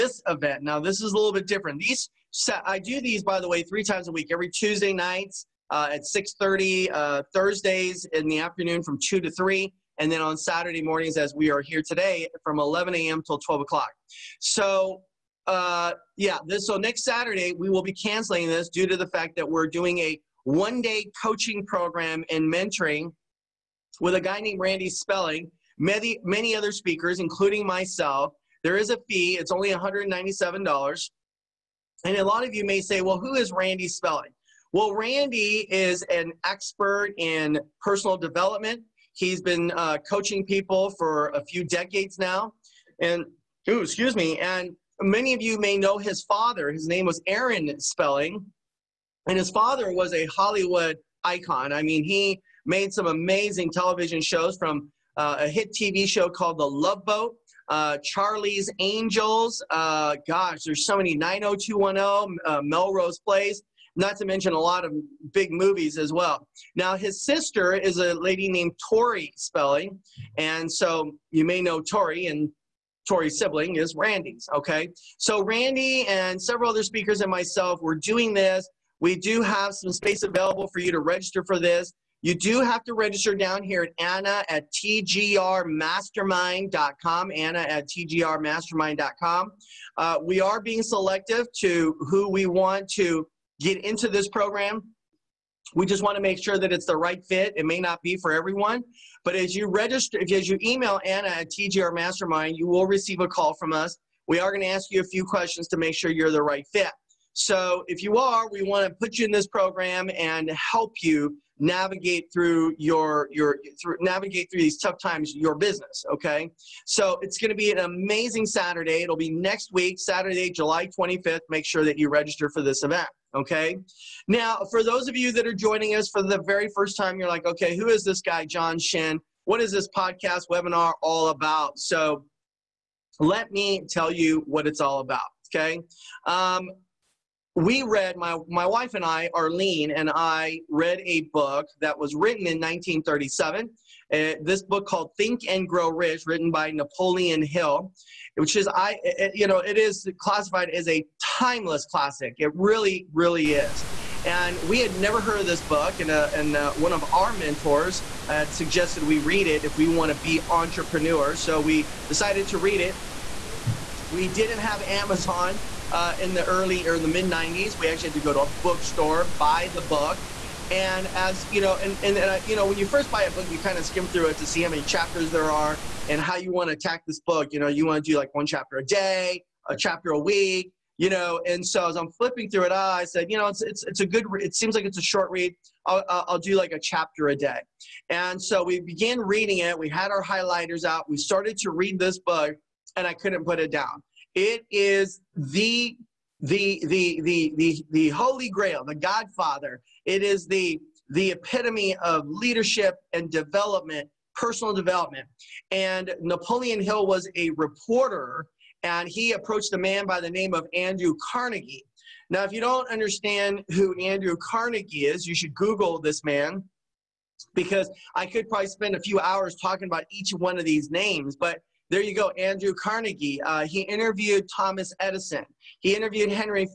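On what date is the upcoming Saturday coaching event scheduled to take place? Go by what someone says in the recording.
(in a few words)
July 25th.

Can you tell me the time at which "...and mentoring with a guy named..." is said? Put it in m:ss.
0:22.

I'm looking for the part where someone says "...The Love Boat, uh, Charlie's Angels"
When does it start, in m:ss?
0:56.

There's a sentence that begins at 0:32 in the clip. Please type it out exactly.
And a lot of you may say, well, who is Randy Spelling?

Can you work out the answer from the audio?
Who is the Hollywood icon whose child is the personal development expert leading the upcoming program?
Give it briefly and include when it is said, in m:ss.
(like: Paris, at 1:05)
Aaron Spelling, at 0:47.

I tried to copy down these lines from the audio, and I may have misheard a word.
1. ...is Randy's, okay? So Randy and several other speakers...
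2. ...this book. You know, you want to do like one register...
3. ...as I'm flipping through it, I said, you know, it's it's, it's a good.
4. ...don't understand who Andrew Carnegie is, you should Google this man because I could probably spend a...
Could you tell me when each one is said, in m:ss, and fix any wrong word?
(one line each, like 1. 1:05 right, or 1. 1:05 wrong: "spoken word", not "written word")
1. 1:13 right
2. 2:57 wrong: "chapter", not "register"
3. 3:01 right
4. 3:32 right.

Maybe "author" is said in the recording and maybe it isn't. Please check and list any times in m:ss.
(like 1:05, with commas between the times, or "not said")
not said.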